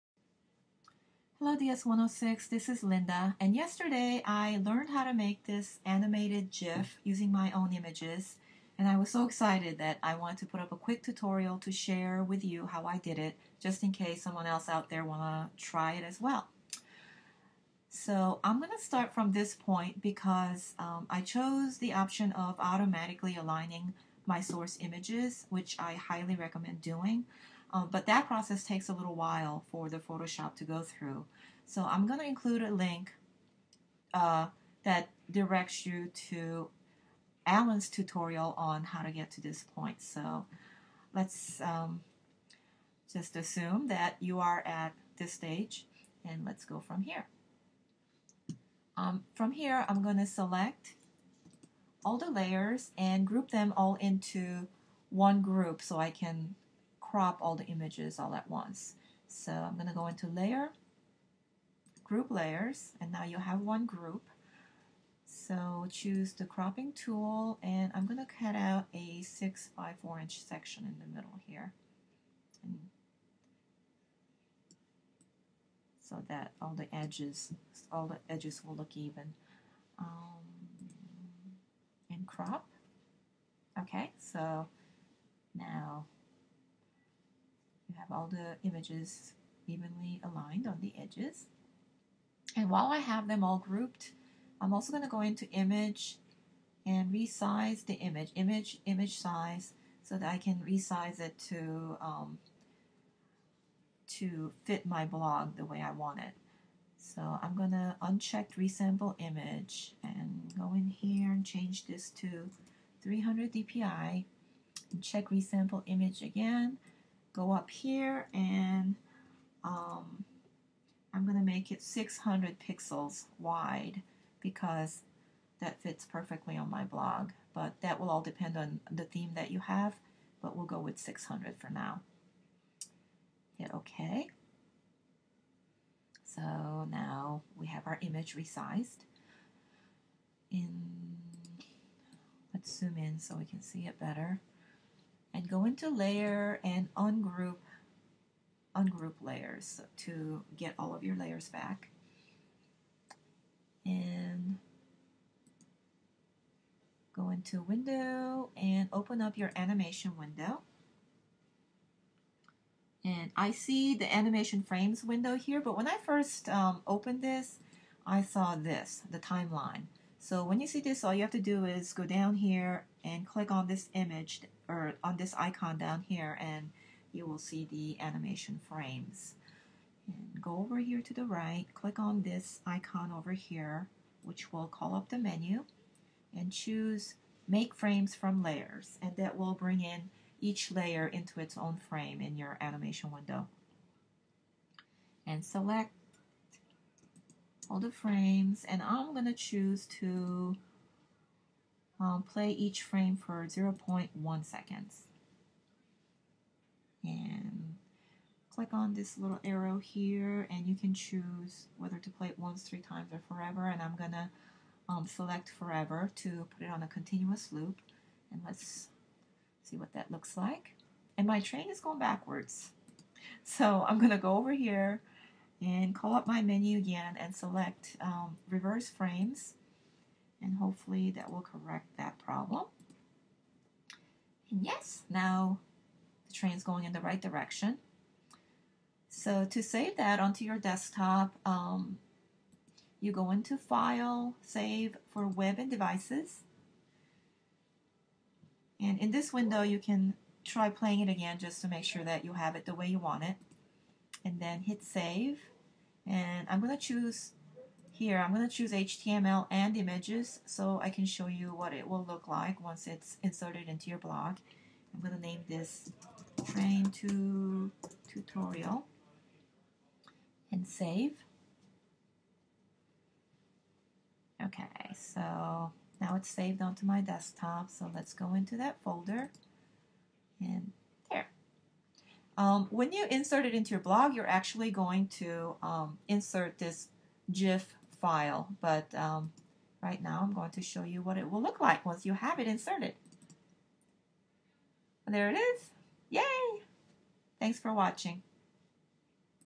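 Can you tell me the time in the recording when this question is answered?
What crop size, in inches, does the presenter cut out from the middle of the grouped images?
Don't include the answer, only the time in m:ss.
1:09.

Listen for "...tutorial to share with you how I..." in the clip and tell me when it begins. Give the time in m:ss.
0:11.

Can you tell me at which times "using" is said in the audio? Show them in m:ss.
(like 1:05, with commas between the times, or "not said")
0:07.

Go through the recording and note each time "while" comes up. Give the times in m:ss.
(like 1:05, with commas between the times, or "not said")
0:29, 1:32.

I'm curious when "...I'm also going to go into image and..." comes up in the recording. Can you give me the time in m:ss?
1:34.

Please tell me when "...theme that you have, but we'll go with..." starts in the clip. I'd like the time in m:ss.
2:09.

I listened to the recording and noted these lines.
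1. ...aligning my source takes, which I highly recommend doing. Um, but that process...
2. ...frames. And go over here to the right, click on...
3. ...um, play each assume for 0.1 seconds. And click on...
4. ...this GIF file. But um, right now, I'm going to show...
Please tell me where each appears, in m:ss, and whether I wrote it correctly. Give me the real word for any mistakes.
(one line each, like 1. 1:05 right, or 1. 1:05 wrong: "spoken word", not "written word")
1. 0:23 wrong: "images", not "takes"
2. 2:58 right
3. 3:22 wrong: "frame", not "assume"
4. 4:46 right.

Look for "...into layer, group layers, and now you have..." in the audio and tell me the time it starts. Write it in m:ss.
1:00.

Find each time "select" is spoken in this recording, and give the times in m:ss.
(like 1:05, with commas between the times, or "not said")
0:50, 3:15, 3:35, 3:47.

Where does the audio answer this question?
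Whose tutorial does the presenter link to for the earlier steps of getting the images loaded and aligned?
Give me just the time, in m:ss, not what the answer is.
0:37.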